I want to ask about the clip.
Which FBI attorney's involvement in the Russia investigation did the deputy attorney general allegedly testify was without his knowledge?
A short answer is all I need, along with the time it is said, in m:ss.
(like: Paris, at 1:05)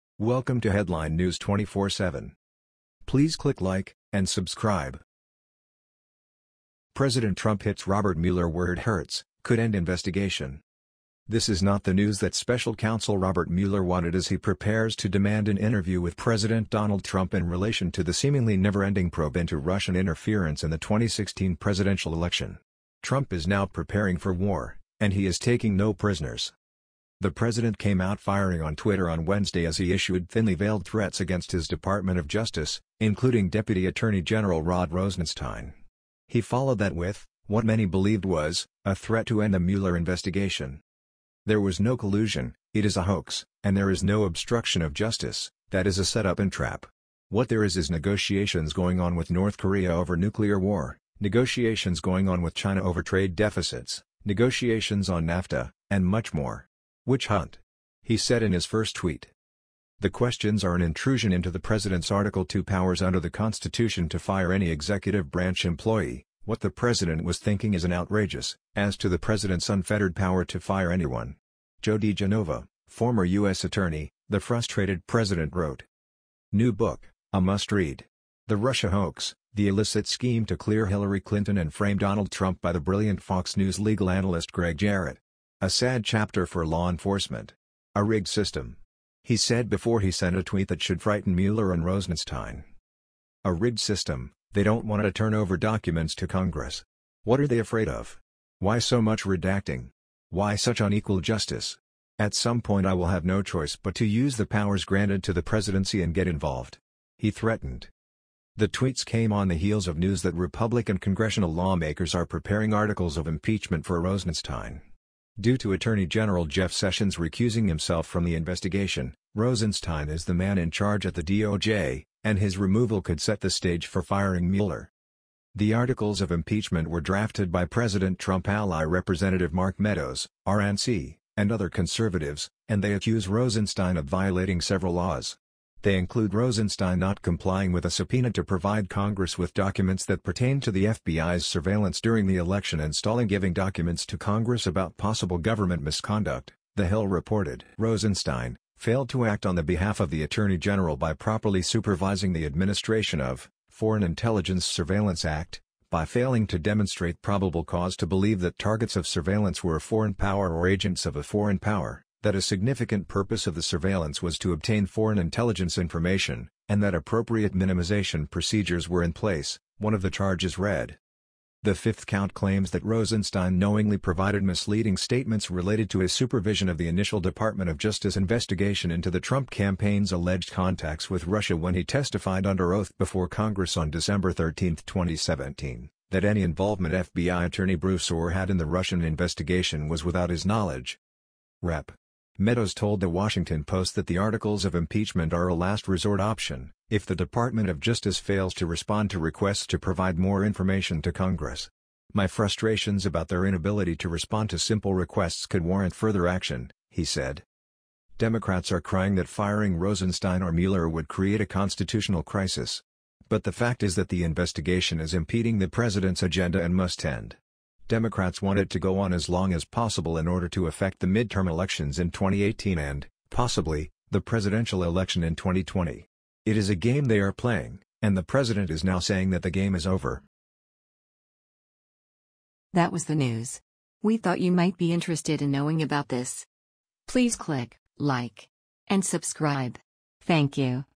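Bruce Ohr, at 3:07.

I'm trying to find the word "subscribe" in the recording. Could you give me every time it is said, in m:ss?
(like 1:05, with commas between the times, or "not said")
0:04, 3:59.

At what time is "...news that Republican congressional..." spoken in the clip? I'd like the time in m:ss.
1:49.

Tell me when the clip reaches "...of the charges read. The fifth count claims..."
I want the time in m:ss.
2:49.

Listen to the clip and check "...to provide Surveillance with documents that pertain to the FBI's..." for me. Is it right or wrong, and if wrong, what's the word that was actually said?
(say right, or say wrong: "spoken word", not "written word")
wrong: "Congress", not "Surveillance".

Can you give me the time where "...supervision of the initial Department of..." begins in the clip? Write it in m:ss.
2:56.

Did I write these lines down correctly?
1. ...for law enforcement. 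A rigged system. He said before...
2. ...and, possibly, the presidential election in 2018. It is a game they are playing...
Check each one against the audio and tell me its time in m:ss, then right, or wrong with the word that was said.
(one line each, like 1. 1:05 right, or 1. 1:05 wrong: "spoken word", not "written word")
1. 1:26 right
2. 3:42 wrong: "2020", not "2018".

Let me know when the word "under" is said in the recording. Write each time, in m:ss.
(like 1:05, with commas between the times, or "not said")
1:03, 3:02.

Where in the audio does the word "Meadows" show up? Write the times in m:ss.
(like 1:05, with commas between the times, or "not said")
2:09, 3:12.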